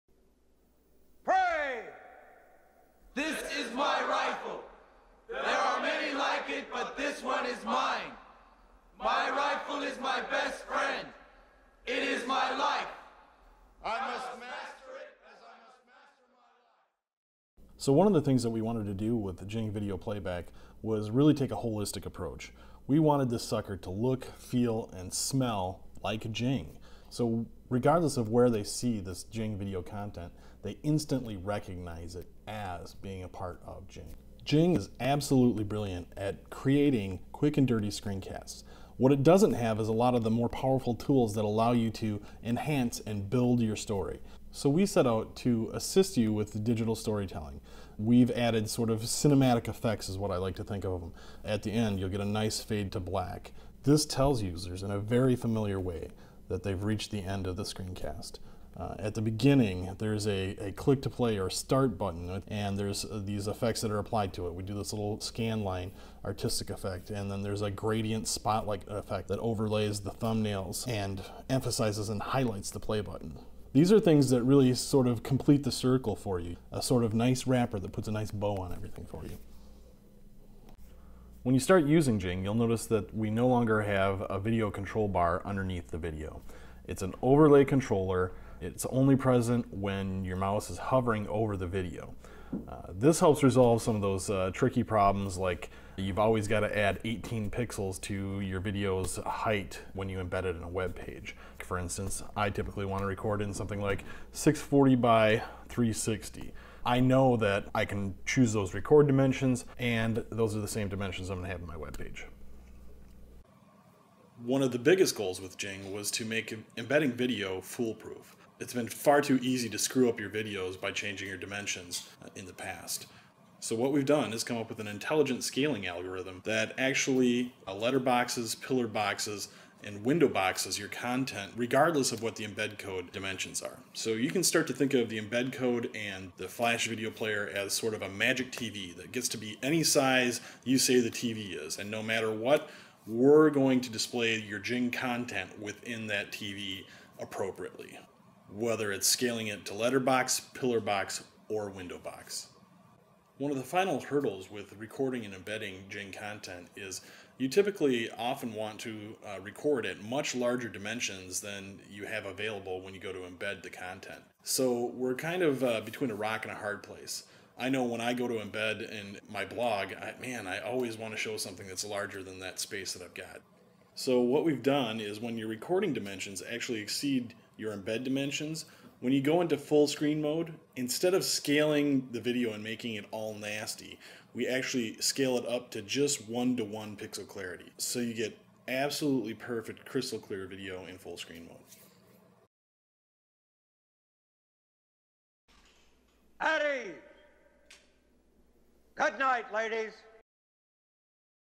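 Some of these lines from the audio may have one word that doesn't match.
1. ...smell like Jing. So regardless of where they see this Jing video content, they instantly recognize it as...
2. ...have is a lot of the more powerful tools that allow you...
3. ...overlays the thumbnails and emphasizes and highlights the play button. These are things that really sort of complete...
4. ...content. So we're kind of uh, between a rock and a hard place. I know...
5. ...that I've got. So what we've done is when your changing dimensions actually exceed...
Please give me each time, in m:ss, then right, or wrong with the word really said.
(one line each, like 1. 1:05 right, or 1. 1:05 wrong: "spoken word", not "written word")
1. 0:25 right
2. 0:39 right
3. 1:09 right
4. 2:43 right
5. 2:52 wrong: "recording", not "changing".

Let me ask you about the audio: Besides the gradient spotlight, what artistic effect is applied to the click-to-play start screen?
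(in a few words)
scan line.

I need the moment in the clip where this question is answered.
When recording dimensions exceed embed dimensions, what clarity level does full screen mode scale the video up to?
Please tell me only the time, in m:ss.
3:06.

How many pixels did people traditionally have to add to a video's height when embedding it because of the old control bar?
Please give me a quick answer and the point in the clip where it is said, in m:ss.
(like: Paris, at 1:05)
18, at 1:37.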